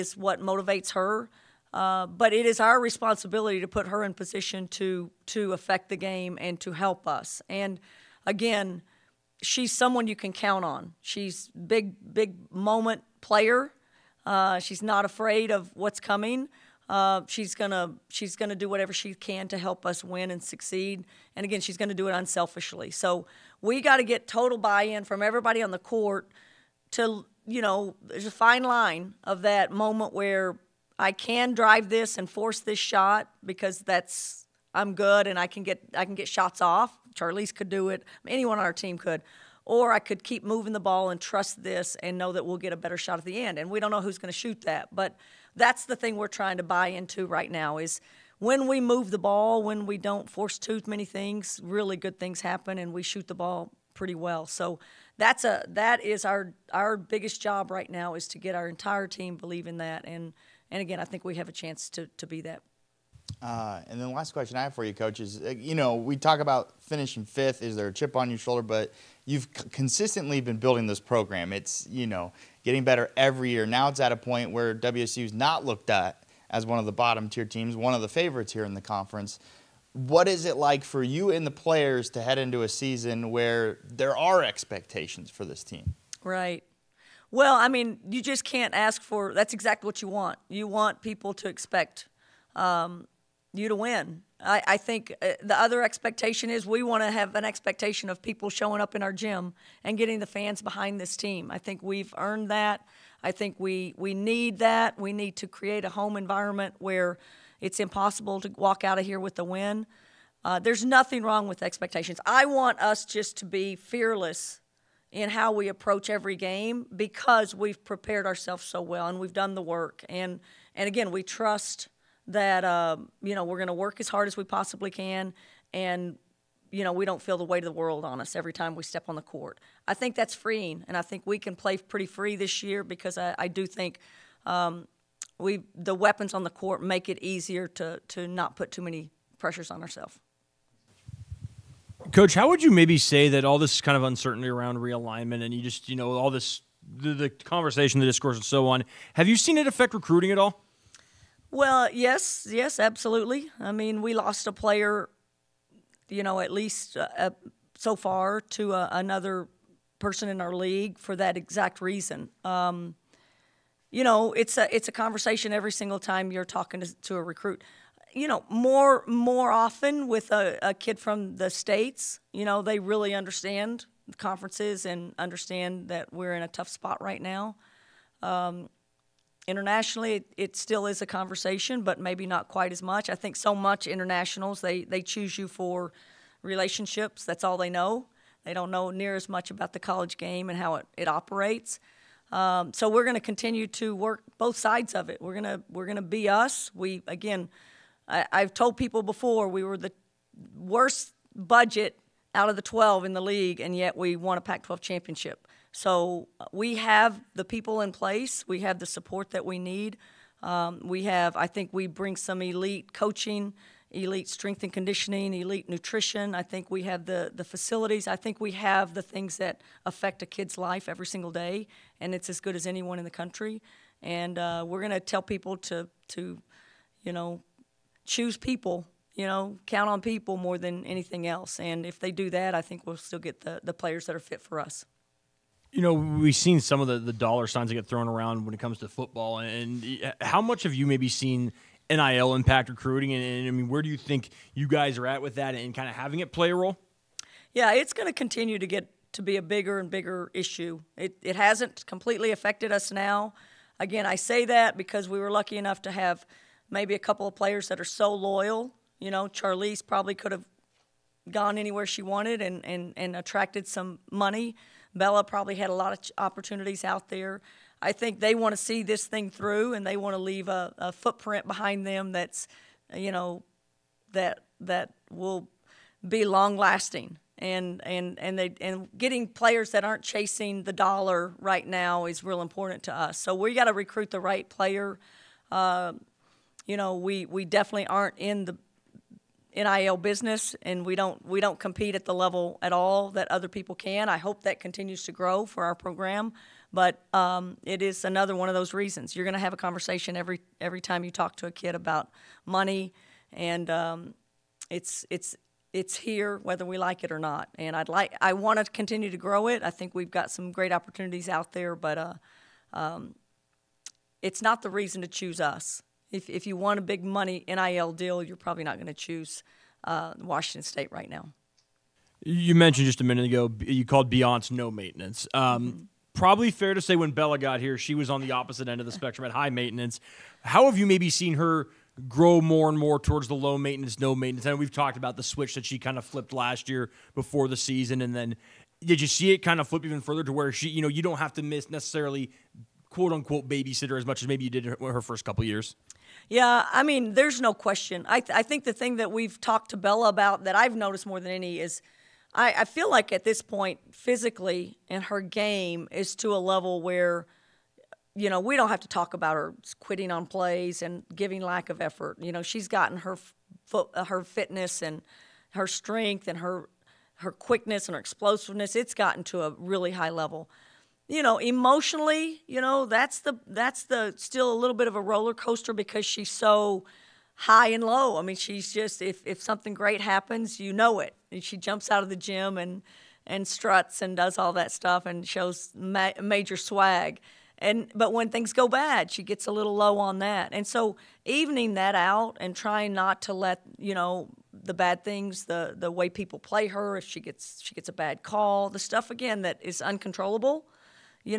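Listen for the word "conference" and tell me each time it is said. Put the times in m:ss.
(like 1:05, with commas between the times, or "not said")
1:18, 2:54.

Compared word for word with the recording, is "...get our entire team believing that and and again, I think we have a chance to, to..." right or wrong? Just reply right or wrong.
right.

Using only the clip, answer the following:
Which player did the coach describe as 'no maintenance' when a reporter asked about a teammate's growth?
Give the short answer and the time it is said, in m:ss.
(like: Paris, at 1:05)
Beyonce, at 5:24.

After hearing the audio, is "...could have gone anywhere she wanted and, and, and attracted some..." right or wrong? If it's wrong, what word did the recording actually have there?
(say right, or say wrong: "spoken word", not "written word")
right.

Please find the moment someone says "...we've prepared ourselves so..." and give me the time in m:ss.
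1:57.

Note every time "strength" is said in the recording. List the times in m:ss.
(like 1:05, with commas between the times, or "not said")
3:34, 6:05.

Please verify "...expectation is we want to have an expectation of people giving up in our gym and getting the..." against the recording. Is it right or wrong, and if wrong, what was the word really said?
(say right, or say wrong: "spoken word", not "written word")
wrong: "showing", not "giving".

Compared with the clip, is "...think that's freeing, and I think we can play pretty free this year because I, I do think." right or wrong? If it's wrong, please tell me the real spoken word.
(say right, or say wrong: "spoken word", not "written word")
right.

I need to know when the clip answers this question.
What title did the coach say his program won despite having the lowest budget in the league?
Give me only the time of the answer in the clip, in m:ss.
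3:24.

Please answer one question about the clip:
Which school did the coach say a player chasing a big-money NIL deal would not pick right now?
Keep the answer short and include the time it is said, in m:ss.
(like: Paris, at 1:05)
Washington State, at 5:20.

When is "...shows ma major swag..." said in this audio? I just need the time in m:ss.
6:25.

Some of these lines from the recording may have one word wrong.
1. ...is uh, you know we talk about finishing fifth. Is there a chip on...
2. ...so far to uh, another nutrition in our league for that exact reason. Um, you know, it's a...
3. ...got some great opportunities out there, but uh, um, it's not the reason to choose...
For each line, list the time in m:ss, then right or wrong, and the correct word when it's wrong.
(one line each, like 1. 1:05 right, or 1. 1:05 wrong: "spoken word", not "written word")
1. 1:05 right
2. 2:37 wrong: "person", not "nutrition"
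3. 5:10 right.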